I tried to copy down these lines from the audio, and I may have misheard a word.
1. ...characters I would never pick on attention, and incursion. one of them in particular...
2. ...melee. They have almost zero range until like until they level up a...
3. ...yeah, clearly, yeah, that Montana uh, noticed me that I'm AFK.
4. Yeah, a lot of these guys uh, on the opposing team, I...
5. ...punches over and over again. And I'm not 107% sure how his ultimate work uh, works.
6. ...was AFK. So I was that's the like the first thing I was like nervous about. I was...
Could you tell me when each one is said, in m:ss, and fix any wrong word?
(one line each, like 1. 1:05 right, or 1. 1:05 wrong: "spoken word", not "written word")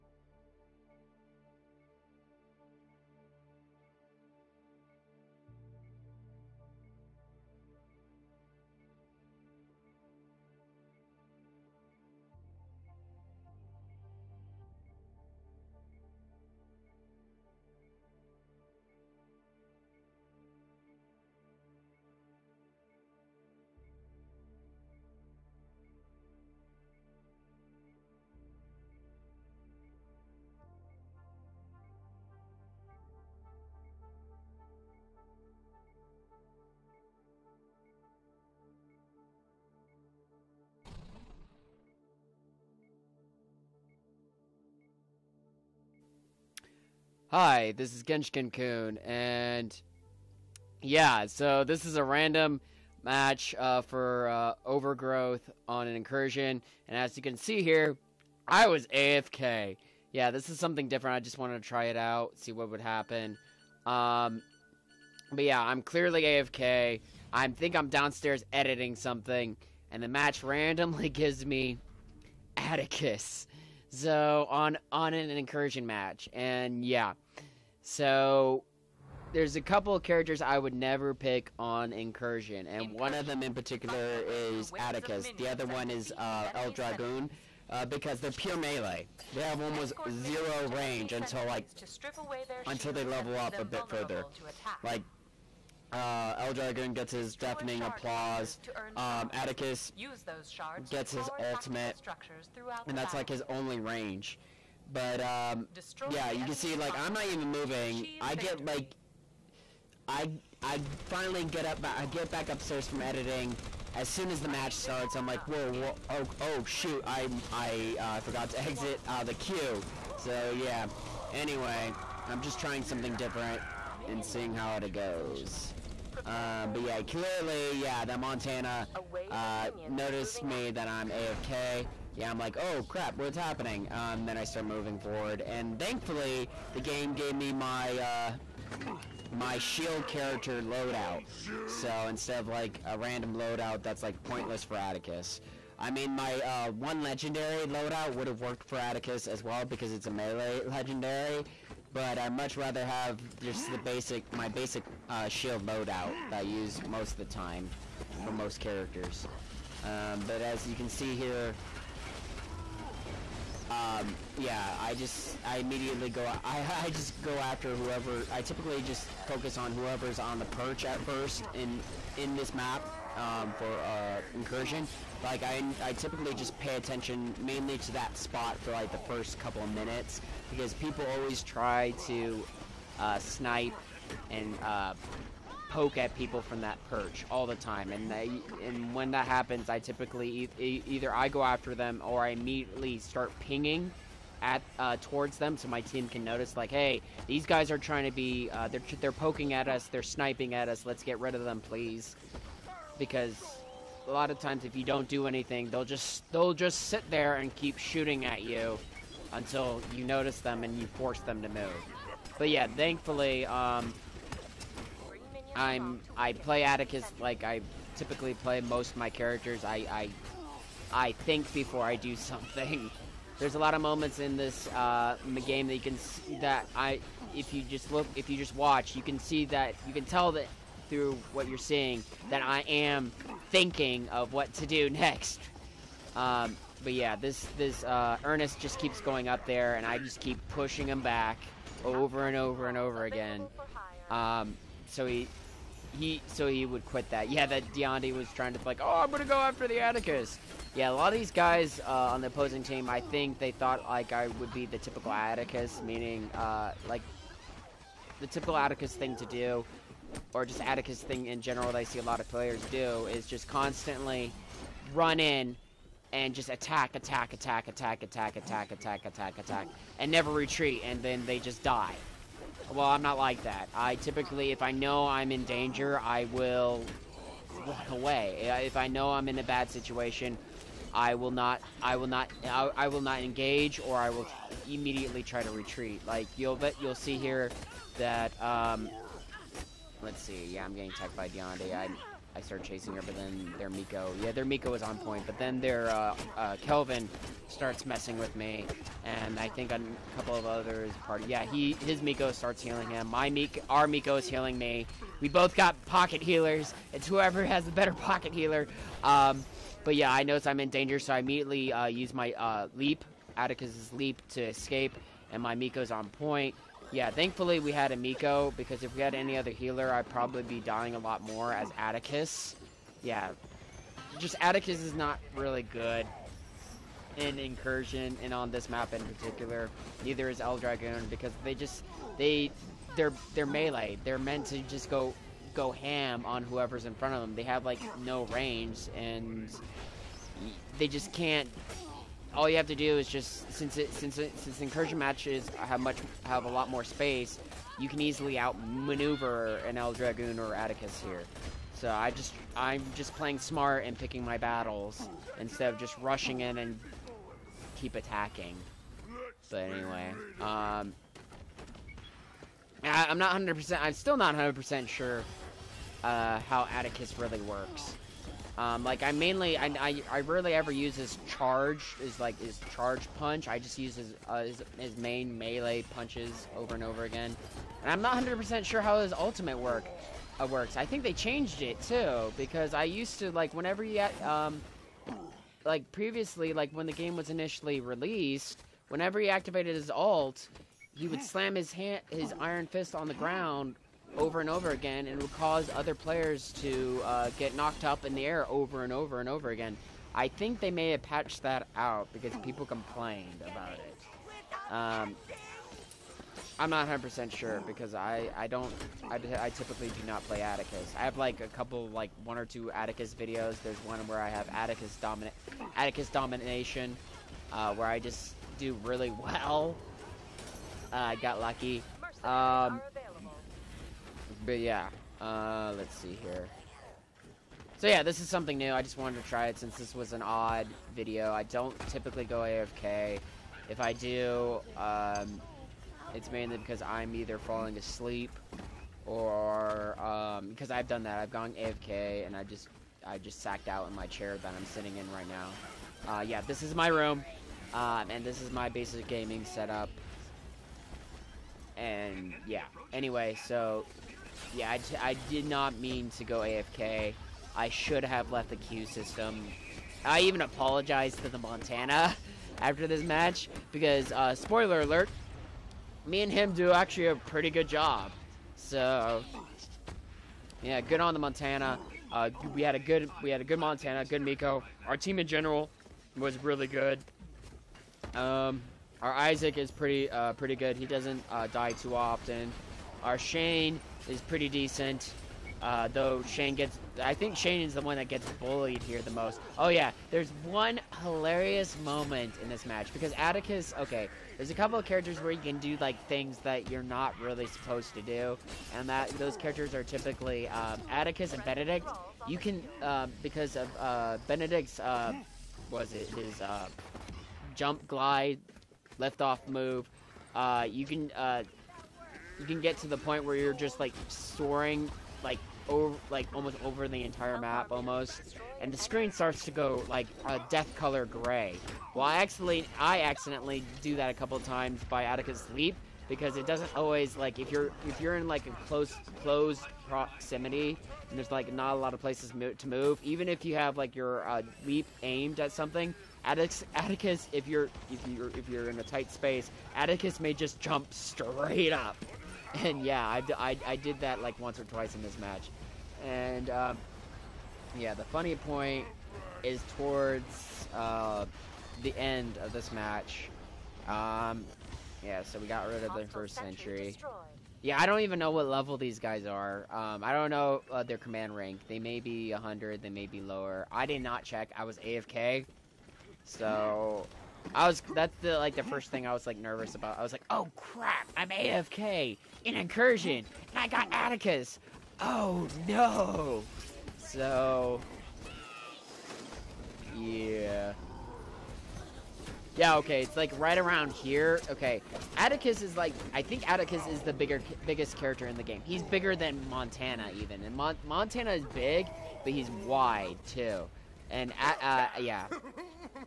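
1. 1:20 wrong: "incursion", not "attention"
2. 1:28 right
3. 2:06 right
4. 4:10 right
5. 6:15 wrong: "100", not "107"
6. 9:24 right.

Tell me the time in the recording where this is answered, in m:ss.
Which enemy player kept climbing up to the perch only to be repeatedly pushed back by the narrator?
3:58.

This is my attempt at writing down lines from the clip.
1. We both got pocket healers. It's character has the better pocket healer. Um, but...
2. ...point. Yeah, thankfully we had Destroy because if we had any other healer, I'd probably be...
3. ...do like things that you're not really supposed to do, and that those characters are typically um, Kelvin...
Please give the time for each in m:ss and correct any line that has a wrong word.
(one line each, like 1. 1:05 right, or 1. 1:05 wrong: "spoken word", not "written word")
1. 5:05 wrong: "whoever", not "character"
2. 5:16 wrong: "Amiko", not "Destroy"
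3. 8:15 wrong: "Attikus", not "Kelvin".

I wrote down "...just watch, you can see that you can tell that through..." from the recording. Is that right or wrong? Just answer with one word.
right.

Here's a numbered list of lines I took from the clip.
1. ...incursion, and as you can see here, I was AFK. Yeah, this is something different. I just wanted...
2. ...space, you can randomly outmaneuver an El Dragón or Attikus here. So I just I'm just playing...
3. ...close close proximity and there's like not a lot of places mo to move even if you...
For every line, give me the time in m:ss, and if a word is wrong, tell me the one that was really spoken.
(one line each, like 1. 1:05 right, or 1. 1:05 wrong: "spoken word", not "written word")
1. 0:55 right
2. 5:46 wrong: "easily", not "randomly"
3. 8:48 right.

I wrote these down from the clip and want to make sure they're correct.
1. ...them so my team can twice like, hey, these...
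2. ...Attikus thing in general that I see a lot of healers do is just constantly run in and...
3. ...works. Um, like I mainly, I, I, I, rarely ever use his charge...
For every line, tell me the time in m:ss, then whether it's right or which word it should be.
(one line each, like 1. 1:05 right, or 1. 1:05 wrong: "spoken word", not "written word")
1. 3:15 wrong: "notice", not "twice"
2. 4:20 wrong: "players", not "healers"
3. 6:07 right.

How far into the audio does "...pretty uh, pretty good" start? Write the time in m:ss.
7:59.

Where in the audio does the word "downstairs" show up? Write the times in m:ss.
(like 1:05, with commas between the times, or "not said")
1:07.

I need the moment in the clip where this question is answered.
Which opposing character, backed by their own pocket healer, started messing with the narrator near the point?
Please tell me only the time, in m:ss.
4:56.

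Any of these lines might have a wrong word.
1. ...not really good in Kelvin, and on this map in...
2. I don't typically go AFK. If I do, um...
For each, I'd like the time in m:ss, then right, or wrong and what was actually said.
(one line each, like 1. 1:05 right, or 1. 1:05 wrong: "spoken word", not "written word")
1. 5:24 wrong: "Incursion", not "Kelvin"
2. 7:11 right.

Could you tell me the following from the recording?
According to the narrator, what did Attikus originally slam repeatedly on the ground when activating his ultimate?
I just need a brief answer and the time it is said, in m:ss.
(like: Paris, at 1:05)
iron fist, at 6:32.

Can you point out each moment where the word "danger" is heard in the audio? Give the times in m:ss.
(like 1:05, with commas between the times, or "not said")
4:35, 5:10.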